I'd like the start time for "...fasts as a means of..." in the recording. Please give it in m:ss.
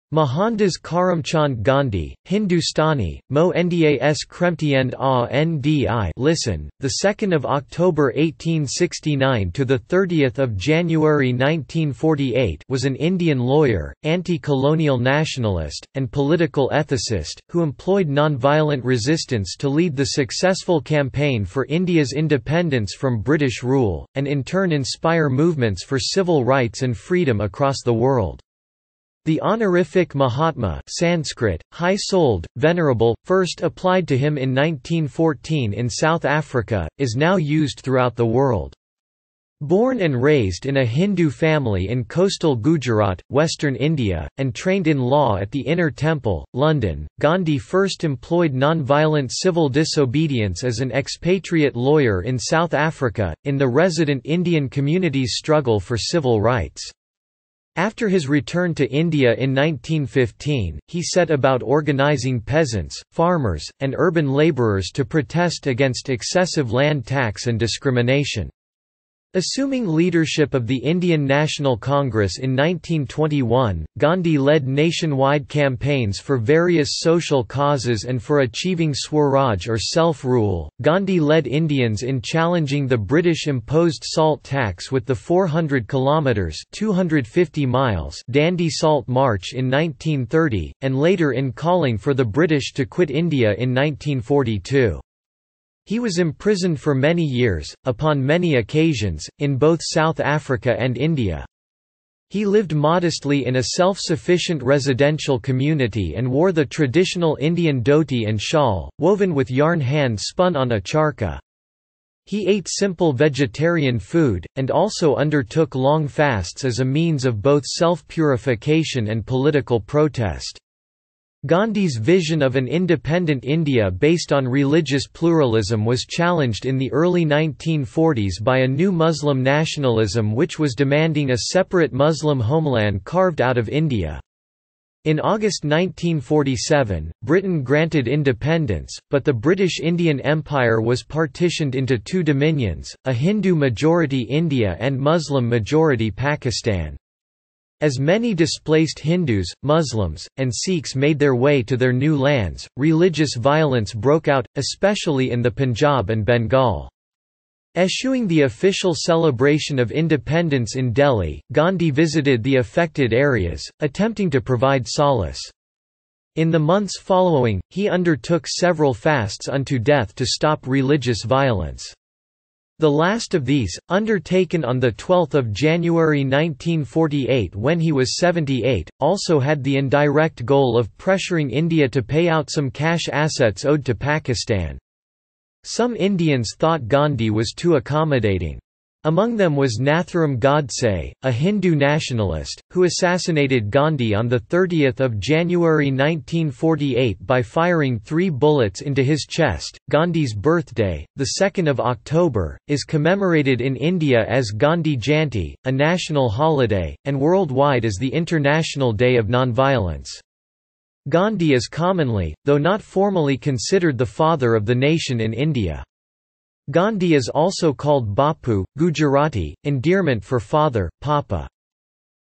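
1:56.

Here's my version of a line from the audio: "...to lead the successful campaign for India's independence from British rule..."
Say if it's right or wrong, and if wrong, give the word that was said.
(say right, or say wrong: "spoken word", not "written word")
right.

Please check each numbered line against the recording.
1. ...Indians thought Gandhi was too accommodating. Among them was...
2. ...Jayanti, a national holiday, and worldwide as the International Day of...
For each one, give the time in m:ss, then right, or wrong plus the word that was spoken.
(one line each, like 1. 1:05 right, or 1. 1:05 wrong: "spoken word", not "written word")
1. 3:05 right
2. 3:24 right.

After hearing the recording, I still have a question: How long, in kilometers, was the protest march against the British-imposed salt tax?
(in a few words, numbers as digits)
400 kilometers.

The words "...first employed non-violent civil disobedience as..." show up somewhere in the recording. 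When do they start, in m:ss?
0:47.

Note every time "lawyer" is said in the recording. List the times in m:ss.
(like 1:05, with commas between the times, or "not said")
0:13, 0:51.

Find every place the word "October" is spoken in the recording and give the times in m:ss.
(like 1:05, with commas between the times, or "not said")
0:07, 3:21.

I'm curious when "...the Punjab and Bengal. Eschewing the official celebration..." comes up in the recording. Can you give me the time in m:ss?
2:35.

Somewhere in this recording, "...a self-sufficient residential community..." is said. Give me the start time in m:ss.
1:43.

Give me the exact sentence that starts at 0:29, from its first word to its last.
The honorific Mahatma Sanskrit, high-souled, venerable, first applied to him in 1914 in South Africa, is now used throughout the world.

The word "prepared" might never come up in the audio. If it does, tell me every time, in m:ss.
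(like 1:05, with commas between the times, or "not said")
not said.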